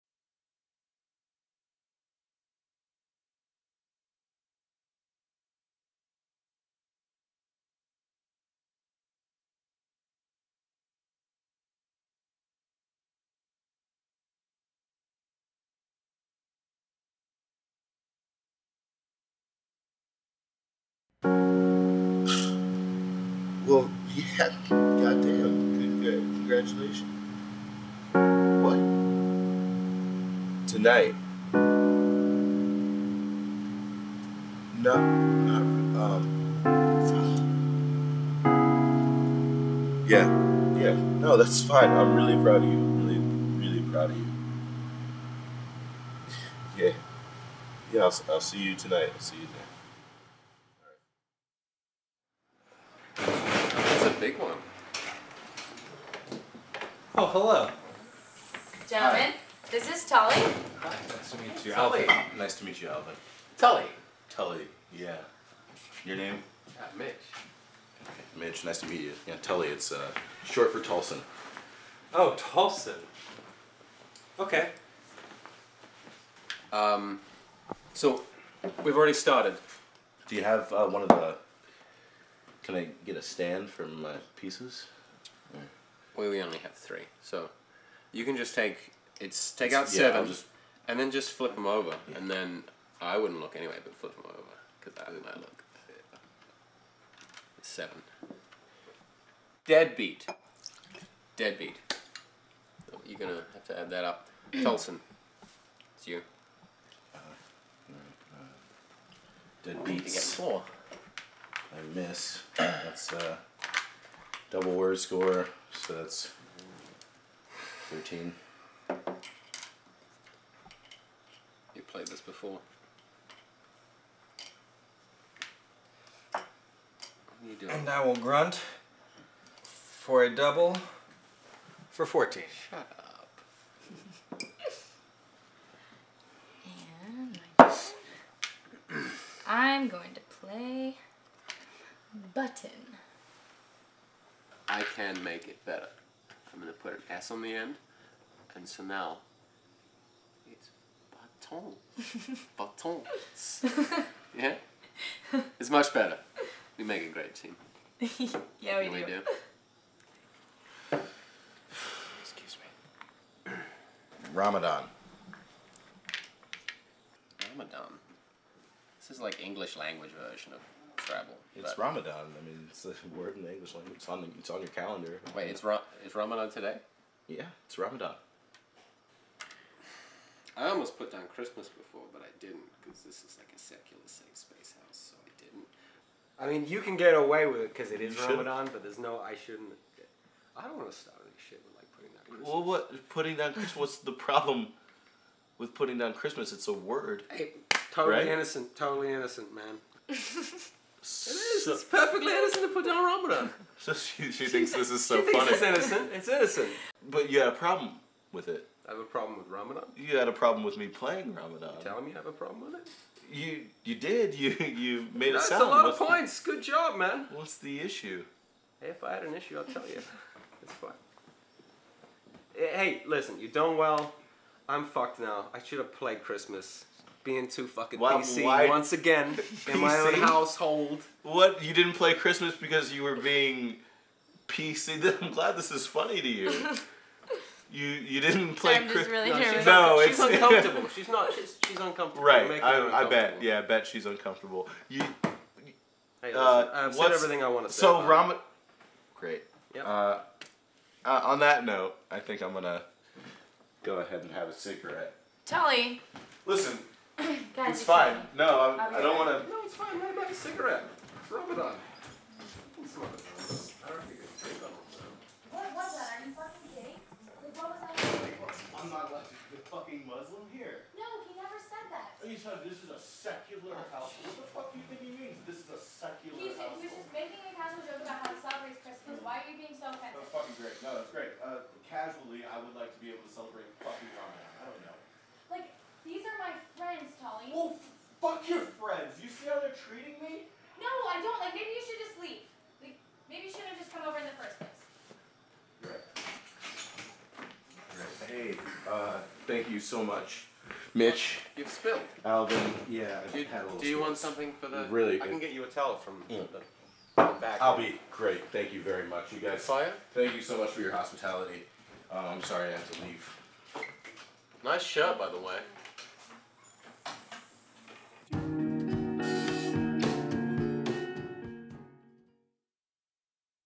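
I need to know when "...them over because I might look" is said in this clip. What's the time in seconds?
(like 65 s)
94 s.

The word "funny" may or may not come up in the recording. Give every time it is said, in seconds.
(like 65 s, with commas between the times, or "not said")
205 s, 235 s.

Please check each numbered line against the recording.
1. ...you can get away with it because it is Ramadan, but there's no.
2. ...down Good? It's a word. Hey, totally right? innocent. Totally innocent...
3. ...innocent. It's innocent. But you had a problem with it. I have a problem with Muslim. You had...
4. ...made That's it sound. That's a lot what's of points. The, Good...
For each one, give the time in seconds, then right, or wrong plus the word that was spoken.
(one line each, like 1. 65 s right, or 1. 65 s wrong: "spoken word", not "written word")
1. 186 s right
2. 195 s wrong: "Christmas", not "Good"
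3. 205 s wrong: "Ramadan", not "Muslim"
4. 215 s right.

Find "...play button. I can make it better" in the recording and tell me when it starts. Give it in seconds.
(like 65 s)
140 s.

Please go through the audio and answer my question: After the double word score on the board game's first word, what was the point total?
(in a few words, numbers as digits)
13.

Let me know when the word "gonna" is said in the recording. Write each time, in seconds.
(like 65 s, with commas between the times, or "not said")
103 s, 252 s.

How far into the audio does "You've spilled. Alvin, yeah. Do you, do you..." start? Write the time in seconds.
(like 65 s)
301 s.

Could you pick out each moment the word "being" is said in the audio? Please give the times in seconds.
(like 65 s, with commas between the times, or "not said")
227 s, 233 s.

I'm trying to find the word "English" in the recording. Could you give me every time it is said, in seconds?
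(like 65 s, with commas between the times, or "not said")
169 s, 173 s.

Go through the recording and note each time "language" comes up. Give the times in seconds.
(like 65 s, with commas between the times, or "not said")
169 s, 173 s.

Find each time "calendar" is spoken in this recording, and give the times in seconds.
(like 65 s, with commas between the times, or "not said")
174 s.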